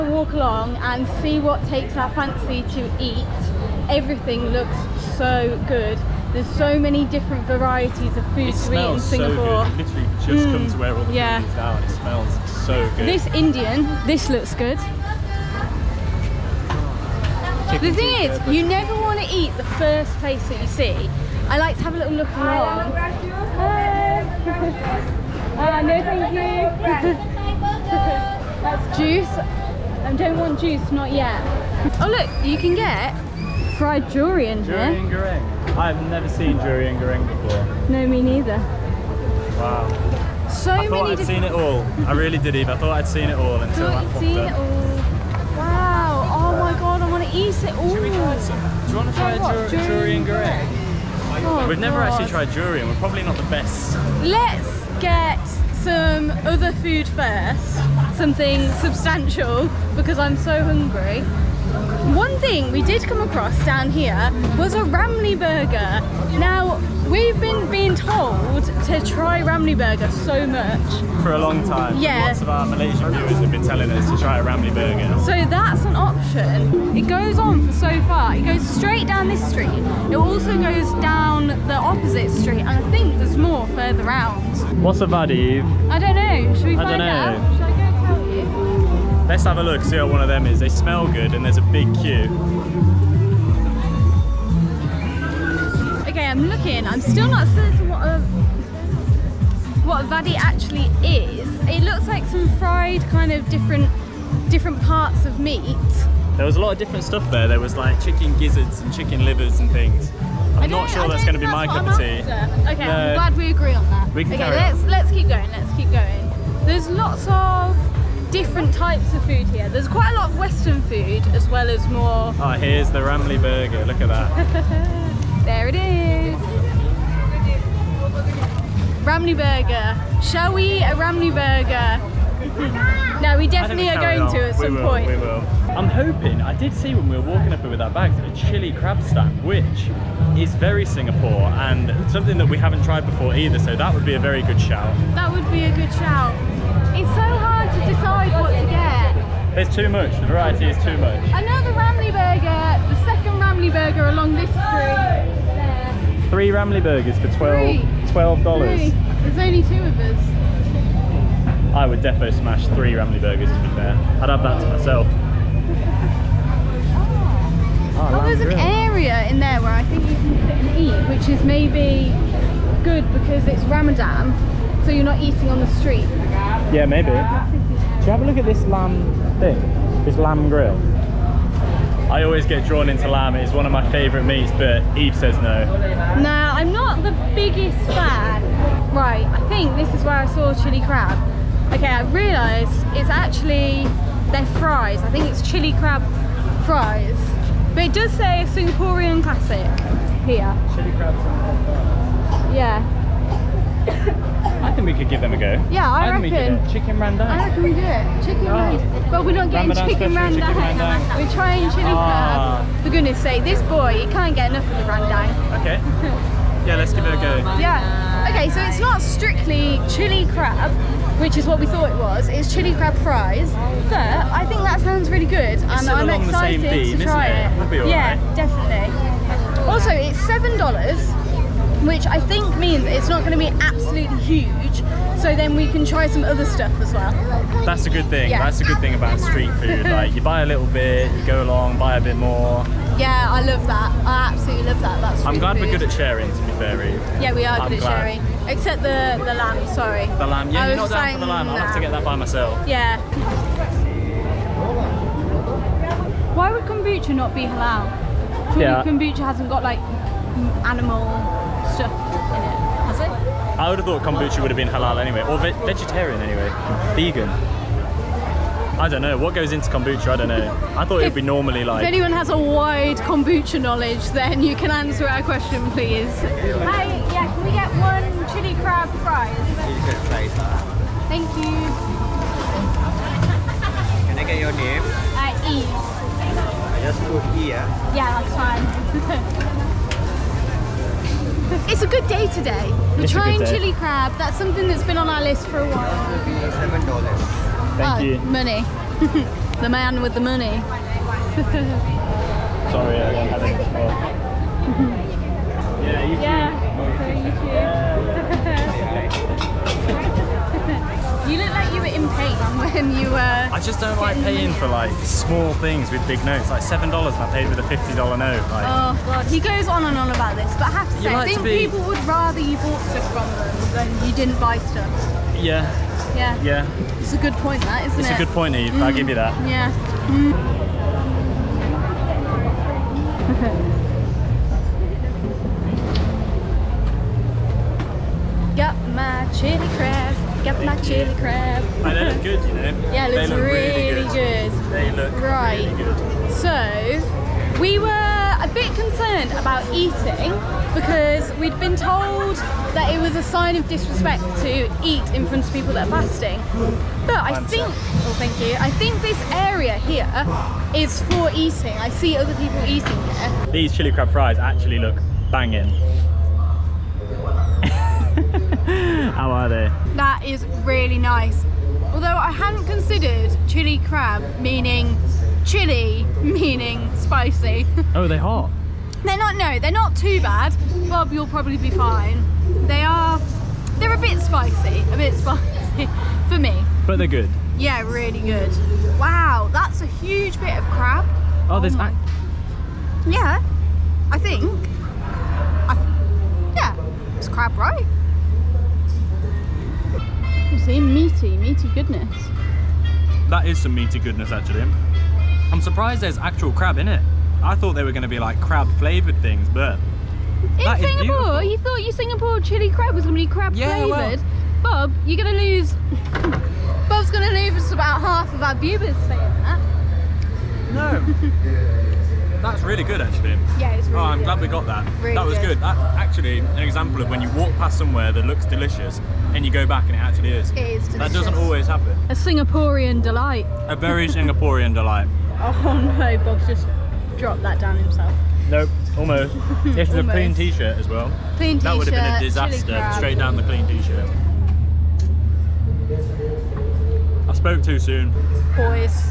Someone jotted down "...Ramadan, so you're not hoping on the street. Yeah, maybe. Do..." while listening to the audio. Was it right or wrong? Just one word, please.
wrong.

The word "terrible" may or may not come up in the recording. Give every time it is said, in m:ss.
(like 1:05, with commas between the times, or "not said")
not said.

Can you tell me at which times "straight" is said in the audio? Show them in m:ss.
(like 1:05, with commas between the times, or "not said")
1:18, 7:22.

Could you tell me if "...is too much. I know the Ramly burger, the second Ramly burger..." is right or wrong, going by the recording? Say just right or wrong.
right.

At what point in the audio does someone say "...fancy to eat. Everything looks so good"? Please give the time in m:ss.
0:02.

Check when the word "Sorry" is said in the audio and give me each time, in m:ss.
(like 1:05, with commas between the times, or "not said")
4:09, 5:02.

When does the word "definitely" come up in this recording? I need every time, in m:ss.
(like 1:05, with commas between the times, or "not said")
2:13, 3:48.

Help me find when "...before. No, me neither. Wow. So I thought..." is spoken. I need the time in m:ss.
0:37.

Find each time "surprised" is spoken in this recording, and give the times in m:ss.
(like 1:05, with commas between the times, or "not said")
6:45.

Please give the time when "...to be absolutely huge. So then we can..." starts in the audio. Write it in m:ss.
3:53.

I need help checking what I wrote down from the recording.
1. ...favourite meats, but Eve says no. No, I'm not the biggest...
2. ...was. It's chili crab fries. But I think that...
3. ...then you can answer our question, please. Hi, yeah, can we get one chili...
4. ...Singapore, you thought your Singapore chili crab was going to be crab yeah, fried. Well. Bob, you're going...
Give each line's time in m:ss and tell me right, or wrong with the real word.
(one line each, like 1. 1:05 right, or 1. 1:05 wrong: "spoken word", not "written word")
1. 3:03 right
2. 3:41 right
3. 4:34 right
4. 6:50 wrong: "flavoured", not "fried".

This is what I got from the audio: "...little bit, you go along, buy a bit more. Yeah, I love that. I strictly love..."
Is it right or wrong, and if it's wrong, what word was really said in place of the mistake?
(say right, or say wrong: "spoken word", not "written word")
wrong: "absolutely", not "strictly".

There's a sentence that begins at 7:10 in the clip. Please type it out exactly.
It is that doesn't always happen.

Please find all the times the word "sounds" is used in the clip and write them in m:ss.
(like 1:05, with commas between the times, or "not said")
3:44.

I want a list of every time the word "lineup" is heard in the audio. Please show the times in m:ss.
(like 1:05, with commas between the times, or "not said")
not said.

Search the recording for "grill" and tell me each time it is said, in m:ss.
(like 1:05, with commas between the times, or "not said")
2:48, 3:00.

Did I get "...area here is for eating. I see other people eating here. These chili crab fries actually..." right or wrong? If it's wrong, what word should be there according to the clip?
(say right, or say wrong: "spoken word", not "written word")
right.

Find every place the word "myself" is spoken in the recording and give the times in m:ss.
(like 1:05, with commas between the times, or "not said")
2:44, 4:12.